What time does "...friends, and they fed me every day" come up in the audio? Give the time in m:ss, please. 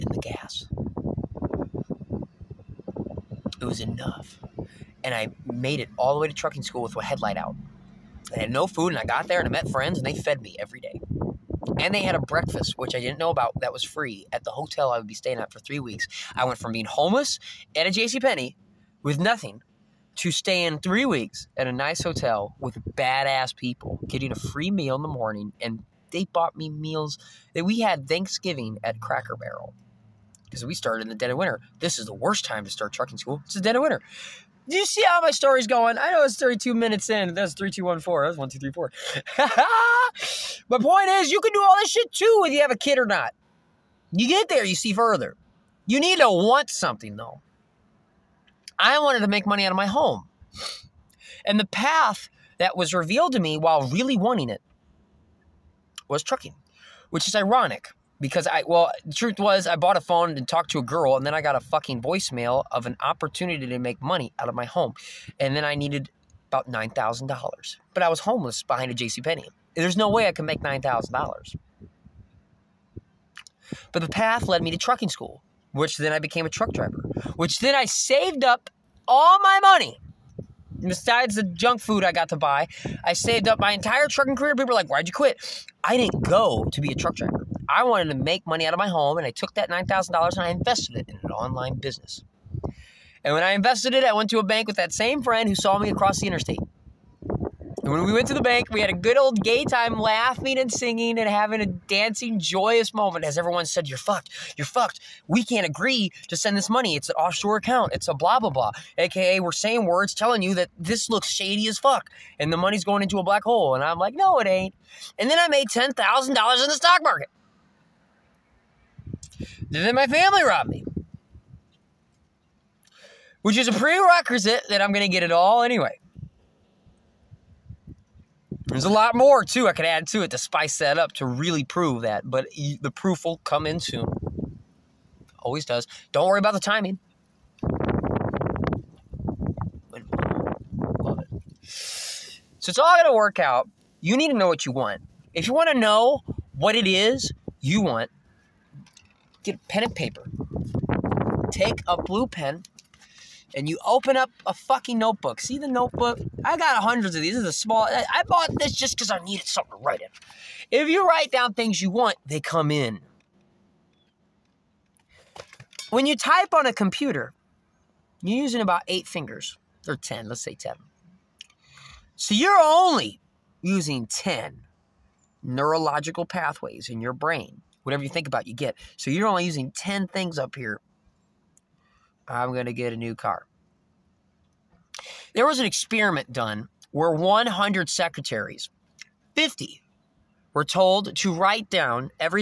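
0:09.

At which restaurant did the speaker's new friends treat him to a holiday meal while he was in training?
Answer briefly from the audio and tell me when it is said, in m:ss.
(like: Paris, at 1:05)
Cracker Barrel, at 0:28.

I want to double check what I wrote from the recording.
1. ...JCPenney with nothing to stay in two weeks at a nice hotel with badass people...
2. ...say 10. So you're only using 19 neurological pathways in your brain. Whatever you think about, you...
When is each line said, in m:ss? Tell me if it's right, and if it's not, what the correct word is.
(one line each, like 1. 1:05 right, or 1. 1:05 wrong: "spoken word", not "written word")
1. 0:17 wrong: "three", not "two"
2. 2:50 wrong: "10", not "19".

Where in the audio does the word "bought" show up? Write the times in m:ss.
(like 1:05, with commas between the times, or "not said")
0:26, 0:59, 2:38.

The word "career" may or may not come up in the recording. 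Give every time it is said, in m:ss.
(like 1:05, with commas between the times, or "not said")
1:24.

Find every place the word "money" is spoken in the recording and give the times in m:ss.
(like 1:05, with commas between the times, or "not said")
0:49, 1:03, 1:19, 1:28, 1:46, 1:52.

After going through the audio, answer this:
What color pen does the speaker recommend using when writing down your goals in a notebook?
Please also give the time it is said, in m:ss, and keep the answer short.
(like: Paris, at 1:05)
blue, at 2:32.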